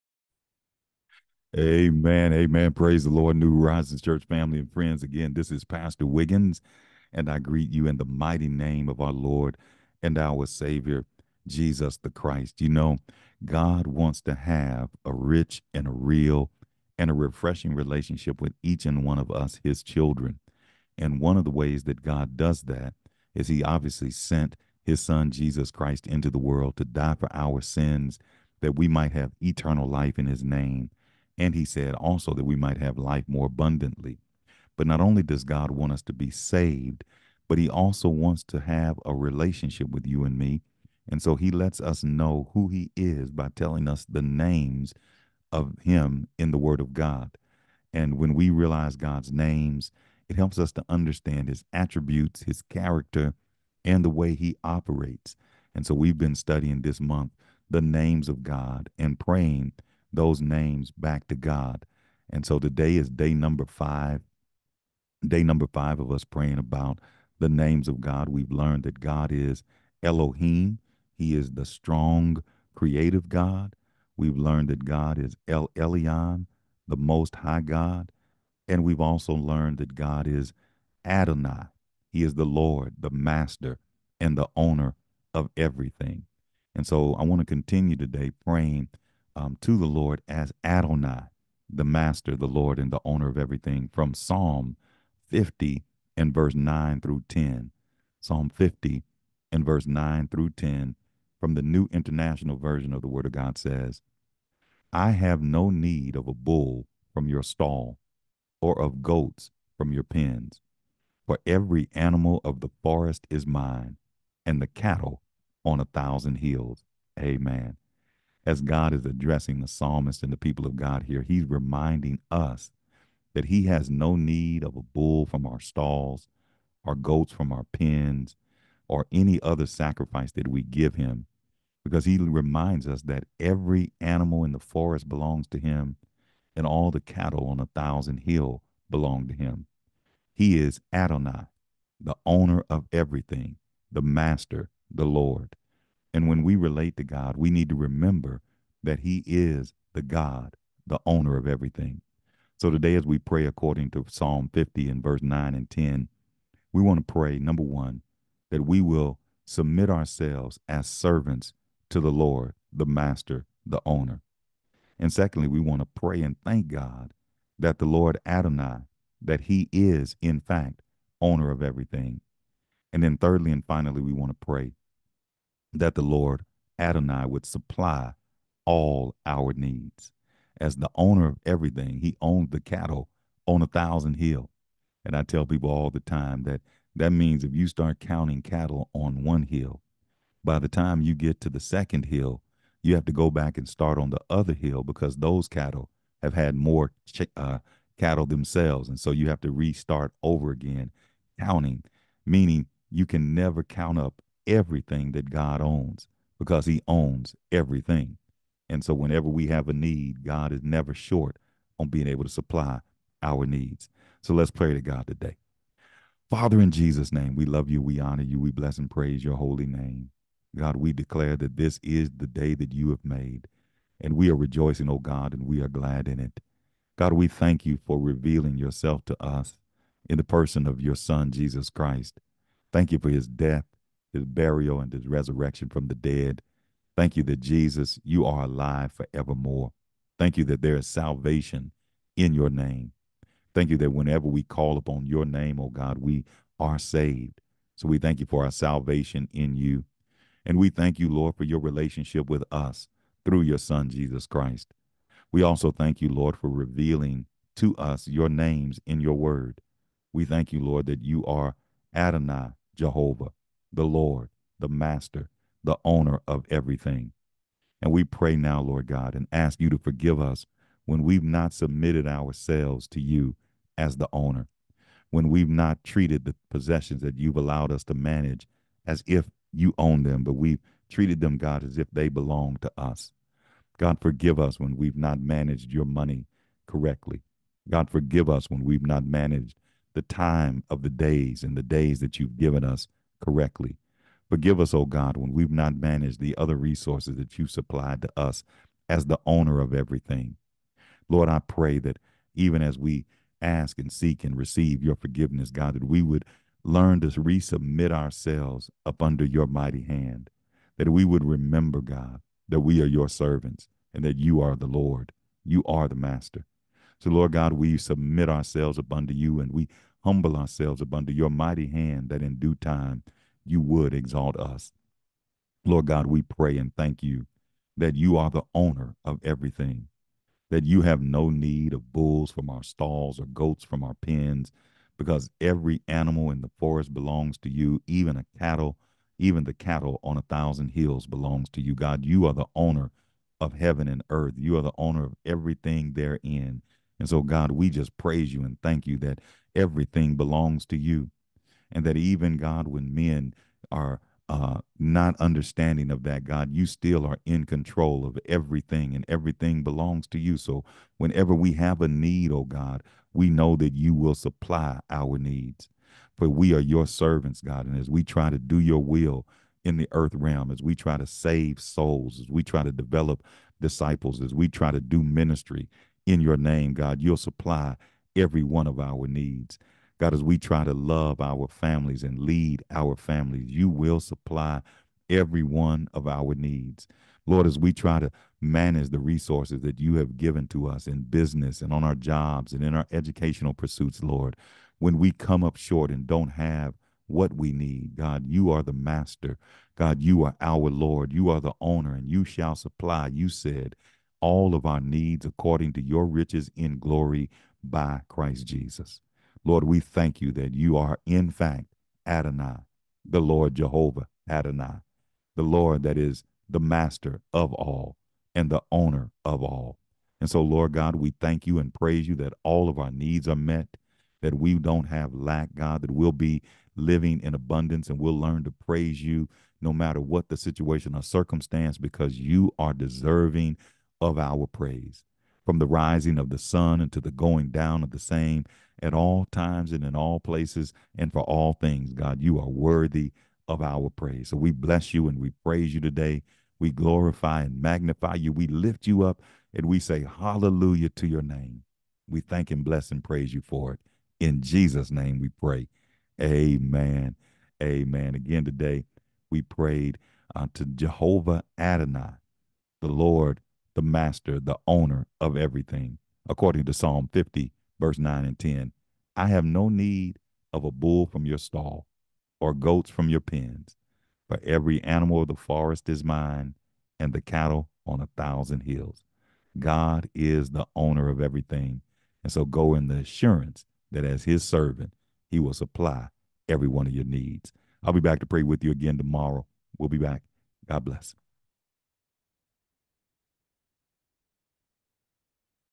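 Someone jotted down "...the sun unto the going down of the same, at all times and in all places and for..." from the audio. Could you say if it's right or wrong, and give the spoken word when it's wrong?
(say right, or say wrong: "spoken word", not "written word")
right.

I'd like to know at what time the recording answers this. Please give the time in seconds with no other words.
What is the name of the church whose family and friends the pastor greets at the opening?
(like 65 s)
3 s.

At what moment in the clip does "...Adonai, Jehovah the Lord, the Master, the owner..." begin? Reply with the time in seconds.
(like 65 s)
261 s.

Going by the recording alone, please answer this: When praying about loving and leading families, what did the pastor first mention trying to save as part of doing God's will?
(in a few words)
souls.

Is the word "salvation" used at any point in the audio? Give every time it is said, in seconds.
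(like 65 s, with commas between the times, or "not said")
240 s, 248 s.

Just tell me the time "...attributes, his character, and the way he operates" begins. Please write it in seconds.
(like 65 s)
51 s.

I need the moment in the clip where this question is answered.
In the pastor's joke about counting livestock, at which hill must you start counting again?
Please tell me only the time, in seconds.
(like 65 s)
191 s.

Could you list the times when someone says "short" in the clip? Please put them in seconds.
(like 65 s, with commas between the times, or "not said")
210 s, 395 s.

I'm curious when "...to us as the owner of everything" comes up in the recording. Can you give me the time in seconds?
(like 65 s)
298 s.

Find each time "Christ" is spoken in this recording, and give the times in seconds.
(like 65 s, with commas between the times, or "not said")
12 s, 25 s, 231 s, 254 s, 408 s.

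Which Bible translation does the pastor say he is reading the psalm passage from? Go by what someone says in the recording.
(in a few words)
New International Version.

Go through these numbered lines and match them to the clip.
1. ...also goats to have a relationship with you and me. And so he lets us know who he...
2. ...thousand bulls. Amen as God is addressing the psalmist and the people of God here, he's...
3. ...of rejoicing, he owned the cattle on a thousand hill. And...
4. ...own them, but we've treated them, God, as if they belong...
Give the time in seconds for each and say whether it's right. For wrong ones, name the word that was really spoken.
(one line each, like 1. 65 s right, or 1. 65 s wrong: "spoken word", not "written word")
1. 37 s wrong: "wants", not "goats"
2. 115 s wrong: "hills", not "bulls"
3. 181 s wrong: "everything", not "rejoicing"
4. 279 s right.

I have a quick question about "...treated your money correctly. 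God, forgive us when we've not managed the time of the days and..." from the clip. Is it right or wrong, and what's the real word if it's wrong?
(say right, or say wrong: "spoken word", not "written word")
wrong: "managed", not "treated".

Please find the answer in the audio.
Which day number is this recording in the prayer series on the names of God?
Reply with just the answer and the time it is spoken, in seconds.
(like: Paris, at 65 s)
5, at 63 s.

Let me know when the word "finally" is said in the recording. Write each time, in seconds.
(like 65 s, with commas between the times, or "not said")
173 s.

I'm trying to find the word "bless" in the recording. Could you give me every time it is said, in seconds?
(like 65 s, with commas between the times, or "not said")
218 s, 444 s, 452 s, 490 s.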